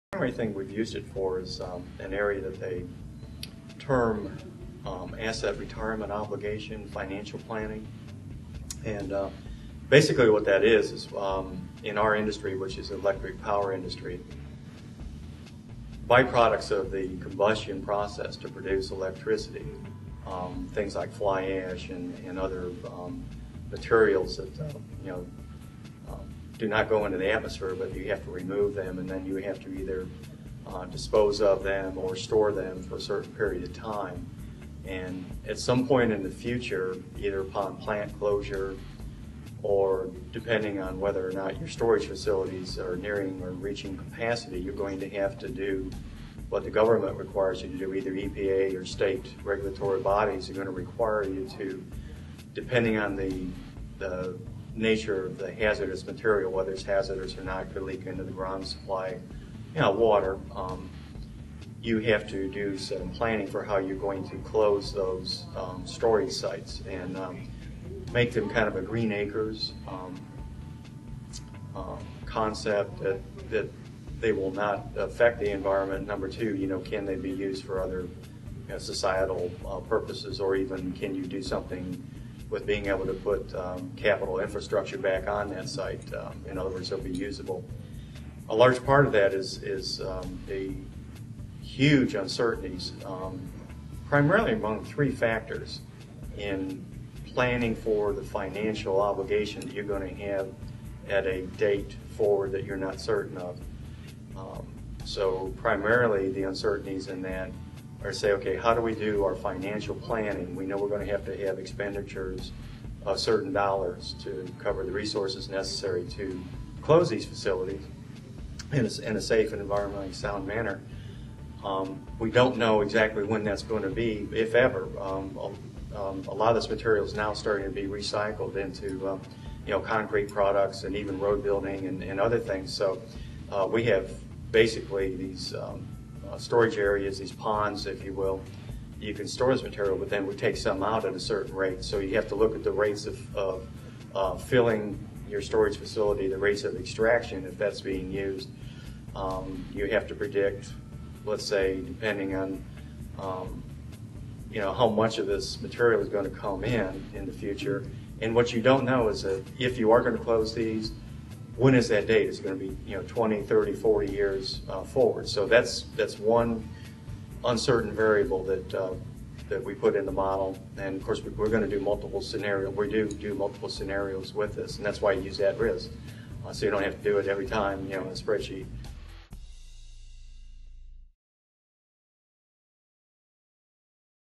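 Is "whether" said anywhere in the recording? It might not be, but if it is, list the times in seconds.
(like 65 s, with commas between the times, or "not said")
40 s, 56 s.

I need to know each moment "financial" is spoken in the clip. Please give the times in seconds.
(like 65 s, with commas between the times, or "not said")
6 s, 98 s, 109 s.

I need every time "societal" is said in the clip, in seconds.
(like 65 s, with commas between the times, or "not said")
78 s.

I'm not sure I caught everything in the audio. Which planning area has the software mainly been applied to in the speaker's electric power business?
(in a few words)
asset retirement obligation.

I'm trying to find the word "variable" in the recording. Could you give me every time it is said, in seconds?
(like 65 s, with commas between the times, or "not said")
167 s.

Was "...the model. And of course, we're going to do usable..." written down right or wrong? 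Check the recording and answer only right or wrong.
wrong.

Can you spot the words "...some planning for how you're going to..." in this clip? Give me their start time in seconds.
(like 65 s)
62 s.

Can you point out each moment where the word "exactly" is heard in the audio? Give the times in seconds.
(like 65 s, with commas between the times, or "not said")
122 s.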